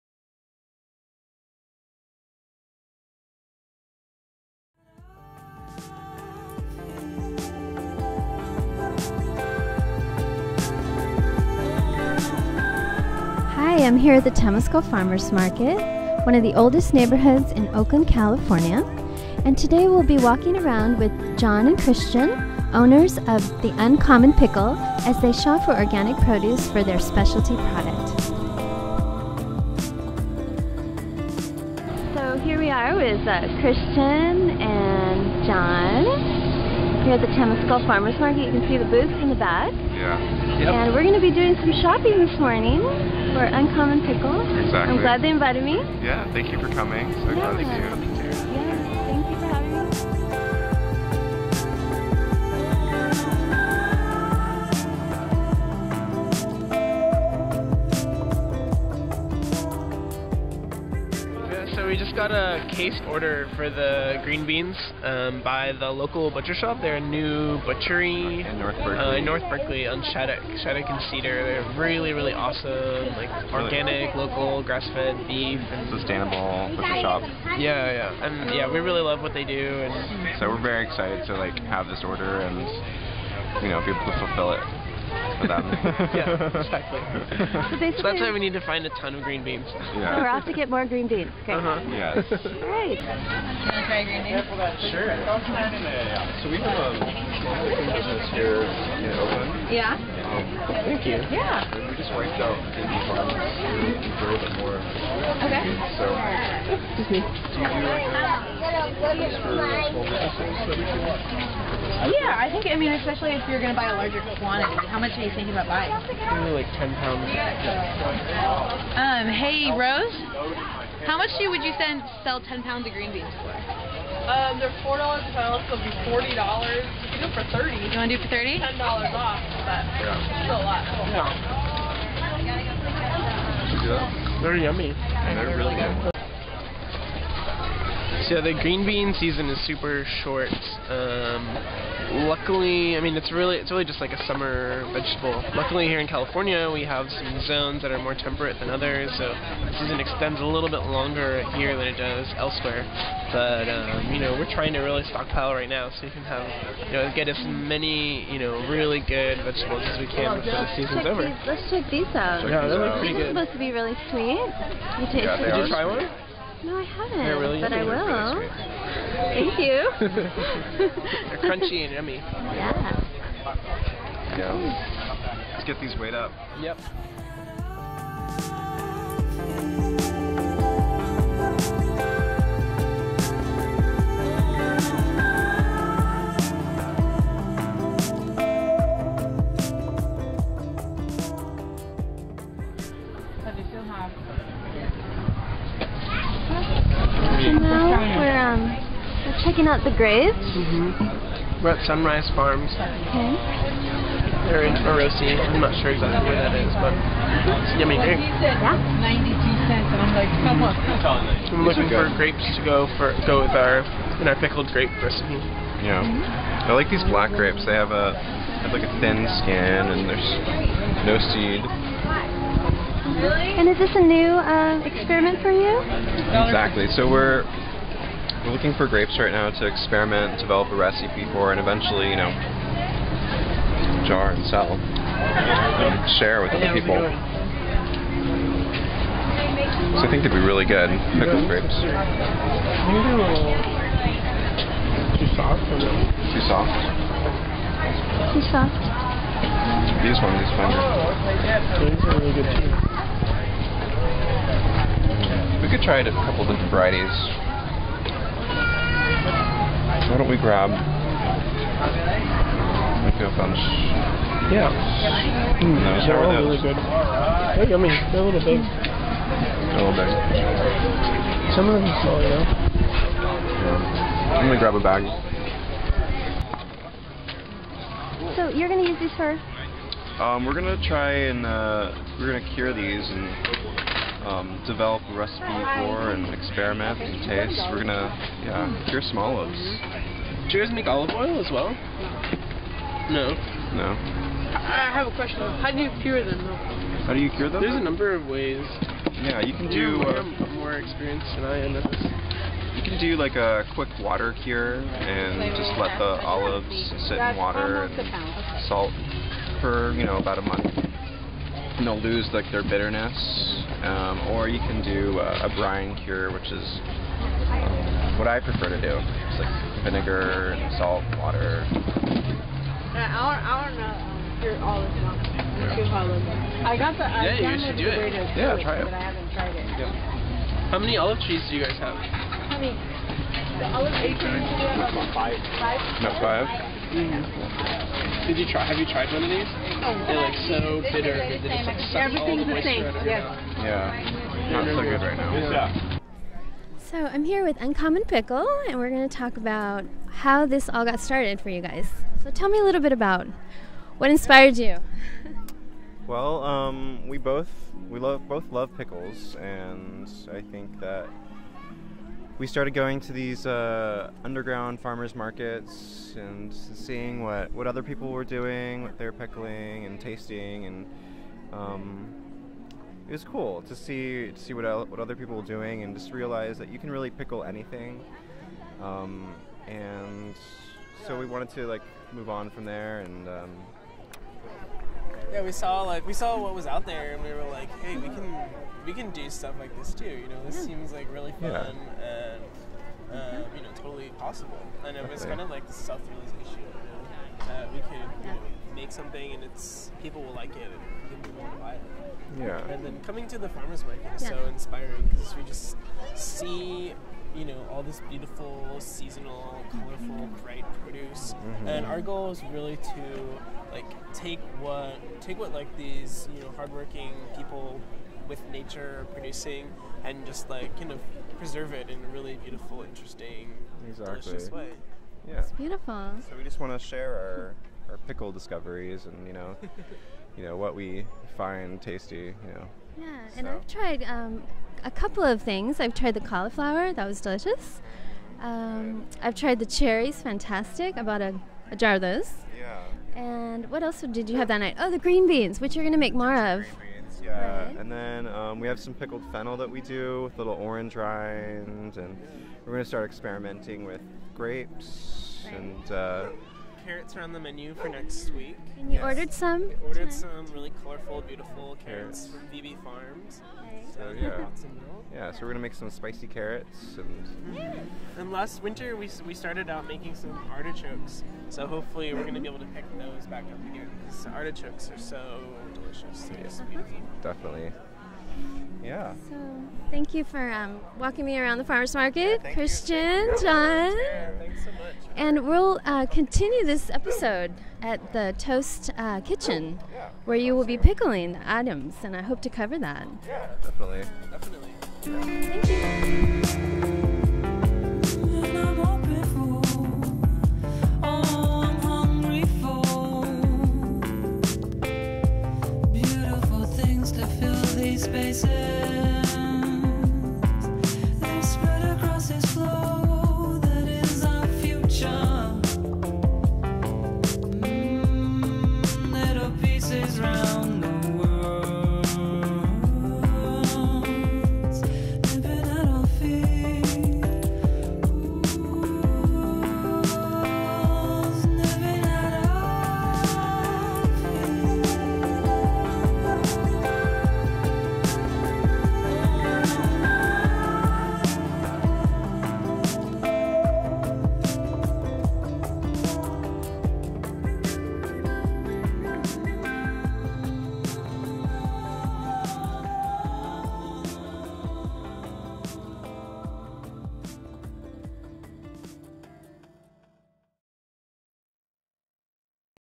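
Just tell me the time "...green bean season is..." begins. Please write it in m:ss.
2:18.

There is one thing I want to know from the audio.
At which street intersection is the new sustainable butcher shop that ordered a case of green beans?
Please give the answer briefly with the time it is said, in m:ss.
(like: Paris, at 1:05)
Shattuck and Cedar, at 1:10.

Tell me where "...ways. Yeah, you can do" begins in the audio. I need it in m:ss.
4:58.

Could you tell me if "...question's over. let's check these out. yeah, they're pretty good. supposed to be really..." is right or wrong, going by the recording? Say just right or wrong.
wrong.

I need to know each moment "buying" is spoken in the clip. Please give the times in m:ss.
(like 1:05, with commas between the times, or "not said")
1:55.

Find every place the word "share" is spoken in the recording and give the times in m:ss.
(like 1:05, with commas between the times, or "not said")
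3:56, 7:06.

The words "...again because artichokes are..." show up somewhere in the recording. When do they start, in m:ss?
7:53.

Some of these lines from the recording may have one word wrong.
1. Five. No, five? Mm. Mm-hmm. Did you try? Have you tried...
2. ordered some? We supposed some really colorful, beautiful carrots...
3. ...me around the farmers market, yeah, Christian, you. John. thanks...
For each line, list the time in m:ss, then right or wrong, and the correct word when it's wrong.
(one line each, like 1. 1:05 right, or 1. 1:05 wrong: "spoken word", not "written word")
1. 5:33 right
2. 7:39 wrong: "ordered", not "supposed"
3. 8:01 right.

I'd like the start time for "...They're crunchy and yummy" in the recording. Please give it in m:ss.
2:51.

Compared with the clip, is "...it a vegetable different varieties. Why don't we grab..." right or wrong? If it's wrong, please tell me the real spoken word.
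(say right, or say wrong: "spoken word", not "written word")
wrong: "couple", not "vegetable".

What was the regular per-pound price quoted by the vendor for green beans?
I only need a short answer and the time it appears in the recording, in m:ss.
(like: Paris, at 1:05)
$4, at 2:04.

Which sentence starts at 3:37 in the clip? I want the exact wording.
They have a have like a thin skin and there's no seed.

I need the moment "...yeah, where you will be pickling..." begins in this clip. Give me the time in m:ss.
8:09.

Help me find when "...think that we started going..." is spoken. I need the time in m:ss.
6:00.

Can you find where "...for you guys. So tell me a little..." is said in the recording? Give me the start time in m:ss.
5:51.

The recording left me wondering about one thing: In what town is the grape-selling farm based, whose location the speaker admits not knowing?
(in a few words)
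Orosi.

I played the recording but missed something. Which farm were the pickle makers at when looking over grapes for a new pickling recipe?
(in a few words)
Sunrise Farms.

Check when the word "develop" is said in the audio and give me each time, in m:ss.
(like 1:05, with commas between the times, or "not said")
3:50, 4:44.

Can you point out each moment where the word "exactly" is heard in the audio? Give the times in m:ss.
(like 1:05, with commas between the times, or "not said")
0:44, 1:26, 3:25, 3:46, 7:03.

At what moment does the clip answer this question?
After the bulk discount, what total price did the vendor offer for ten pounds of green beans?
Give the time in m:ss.
2:06.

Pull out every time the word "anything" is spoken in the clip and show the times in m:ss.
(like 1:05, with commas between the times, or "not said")
6:17.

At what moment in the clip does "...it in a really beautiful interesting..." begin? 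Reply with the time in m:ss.
7:01.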